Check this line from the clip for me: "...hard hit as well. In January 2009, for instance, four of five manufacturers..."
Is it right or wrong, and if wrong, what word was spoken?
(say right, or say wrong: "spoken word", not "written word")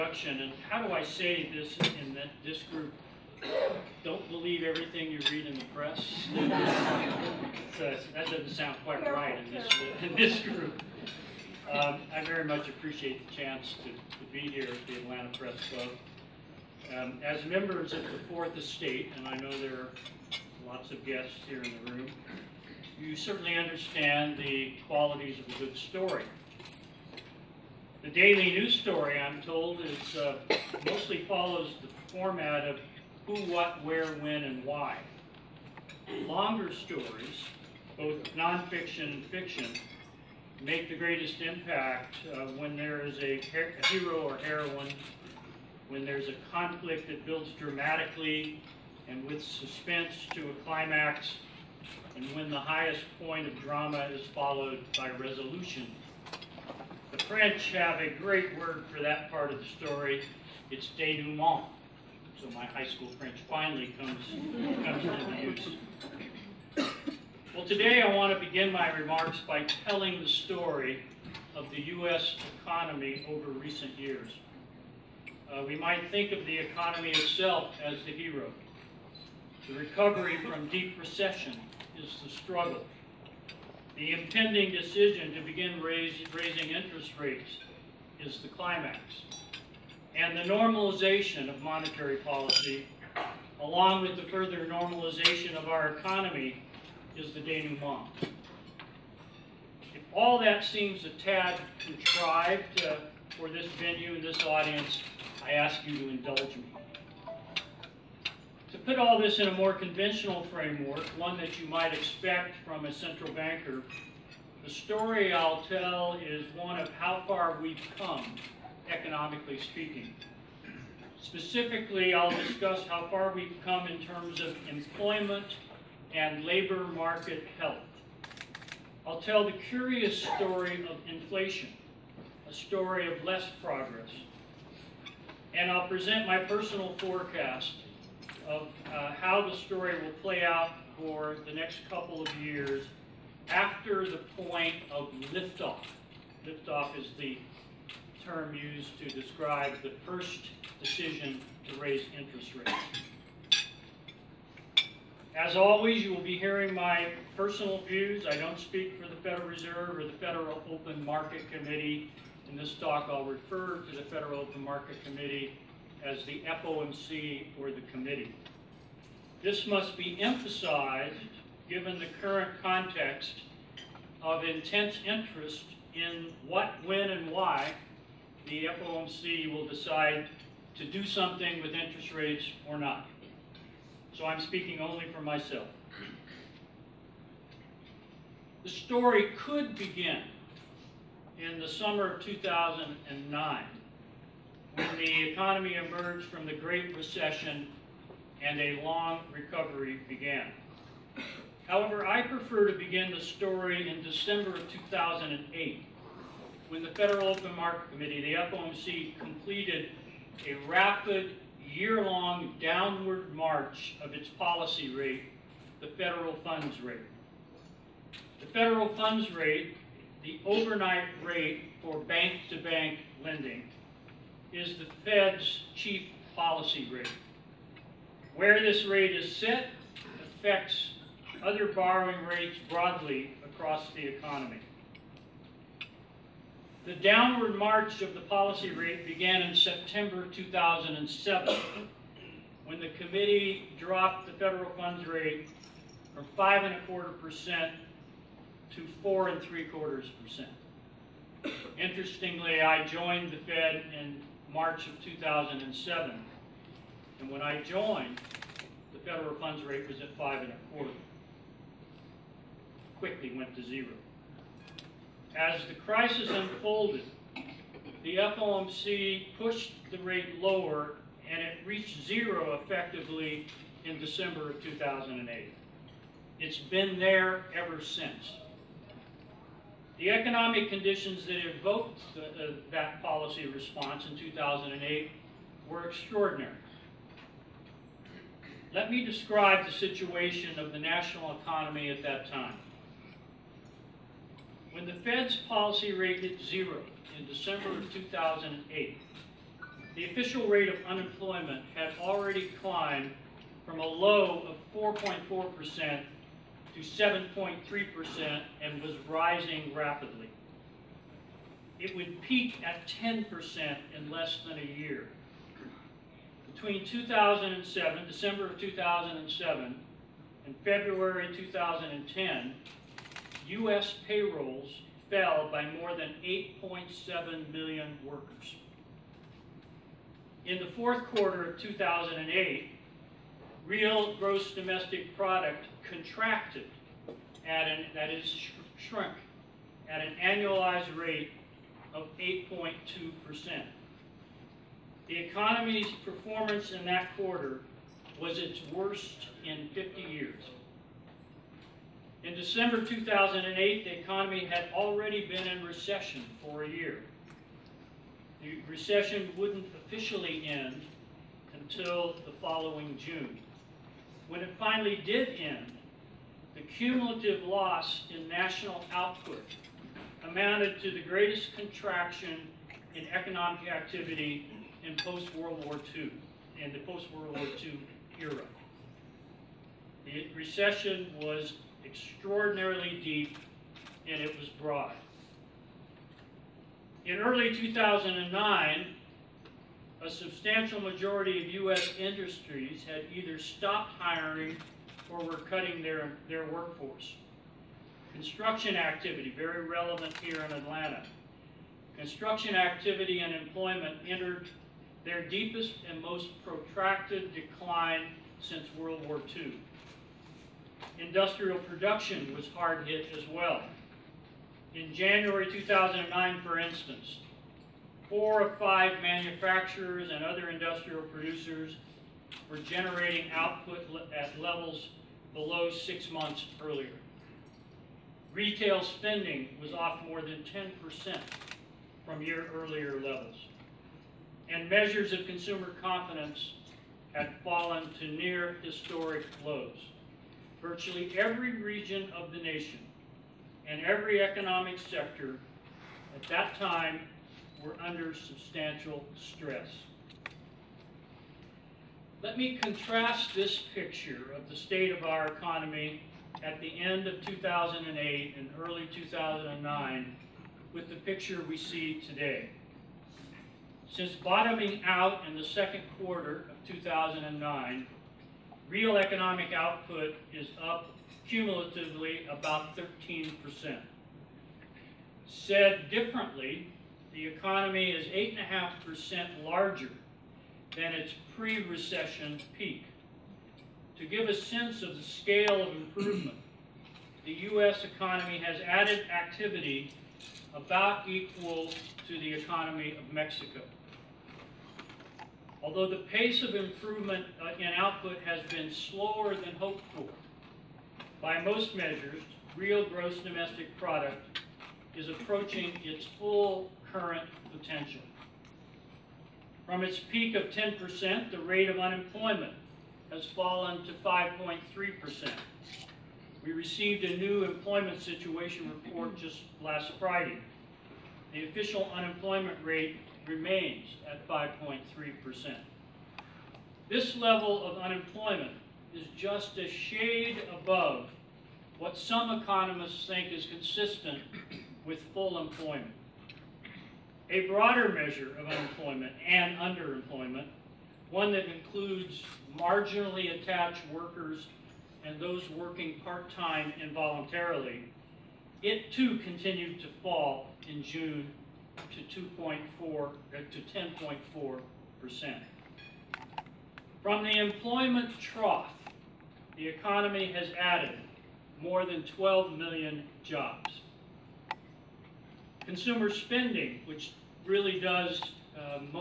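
right.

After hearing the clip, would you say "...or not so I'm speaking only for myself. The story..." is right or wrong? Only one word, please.
right.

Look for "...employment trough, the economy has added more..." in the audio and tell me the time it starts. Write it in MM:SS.
09:17.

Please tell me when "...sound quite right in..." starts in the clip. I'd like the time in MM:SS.
00:08.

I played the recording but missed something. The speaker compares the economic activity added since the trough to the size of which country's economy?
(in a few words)
Mexico.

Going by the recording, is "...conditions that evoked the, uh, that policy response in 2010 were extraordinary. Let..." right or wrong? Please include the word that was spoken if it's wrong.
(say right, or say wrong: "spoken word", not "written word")
wrong: "2008", not "2010".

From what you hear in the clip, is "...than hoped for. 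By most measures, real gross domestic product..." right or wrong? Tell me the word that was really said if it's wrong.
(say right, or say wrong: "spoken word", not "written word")
right.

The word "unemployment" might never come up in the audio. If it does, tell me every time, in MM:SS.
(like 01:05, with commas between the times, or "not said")
05:00, 08:31, 08:41, 08:47, 08:58.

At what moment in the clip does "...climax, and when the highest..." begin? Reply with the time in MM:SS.
00:50.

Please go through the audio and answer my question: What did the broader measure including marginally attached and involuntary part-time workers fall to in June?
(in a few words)
10.4%.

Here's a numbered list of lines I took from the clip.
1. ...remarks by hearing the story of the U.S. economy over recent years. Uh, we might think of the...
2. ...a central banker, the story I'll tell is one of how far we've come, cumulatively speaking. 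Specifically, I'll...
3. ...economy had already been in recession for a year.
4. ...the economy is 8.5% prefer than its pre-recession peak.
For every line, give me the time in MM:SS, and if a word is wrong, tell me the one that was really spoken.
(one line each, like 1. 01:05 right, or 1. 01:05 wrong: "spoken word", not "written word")
1. 01:08 wrong: "telling", not "hearing"
2. 01:52 wrong: "economically", not "cumulatively"
3. 05:53 right
4. 07:57 wrong: "larger", not "prefer".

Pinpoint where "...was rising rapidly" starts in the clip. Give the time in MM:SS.
05:08.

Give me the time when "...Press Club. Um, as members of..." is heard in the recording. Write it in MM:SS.
00:15.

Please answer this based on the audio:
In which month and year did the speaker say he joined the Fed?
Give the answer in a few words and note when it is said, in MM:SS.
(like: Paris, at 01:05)
March 2007, at 04:14.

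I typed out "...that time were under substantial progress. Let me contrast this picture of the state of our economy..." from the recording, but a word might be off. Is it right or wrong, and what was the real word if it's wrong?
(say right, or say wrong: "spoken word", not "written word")
wrong: "stress", not "progress".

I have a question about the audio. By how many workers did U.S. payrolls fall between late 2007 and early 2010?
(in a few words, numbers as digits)
more than 8.7 million.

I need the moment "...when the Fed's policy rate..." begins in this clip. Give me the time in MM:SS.
04:54.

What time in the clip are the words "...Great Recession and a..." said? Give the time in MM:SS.
03:16.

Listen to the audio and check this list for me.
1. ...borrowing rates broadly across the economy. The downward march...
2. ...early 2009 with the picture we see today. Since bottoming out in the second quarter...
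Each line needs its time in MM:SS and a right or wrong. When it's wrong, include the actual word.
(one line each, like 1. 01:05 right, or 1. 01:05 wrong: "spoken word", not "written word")
1. 03:51 right
2. 07:38 right.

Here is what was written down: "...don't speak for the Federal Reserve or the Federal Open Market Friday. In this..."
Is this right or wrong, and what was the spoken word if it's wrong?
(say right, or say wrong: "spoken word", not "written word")
wrong: "Committee", not "Friday".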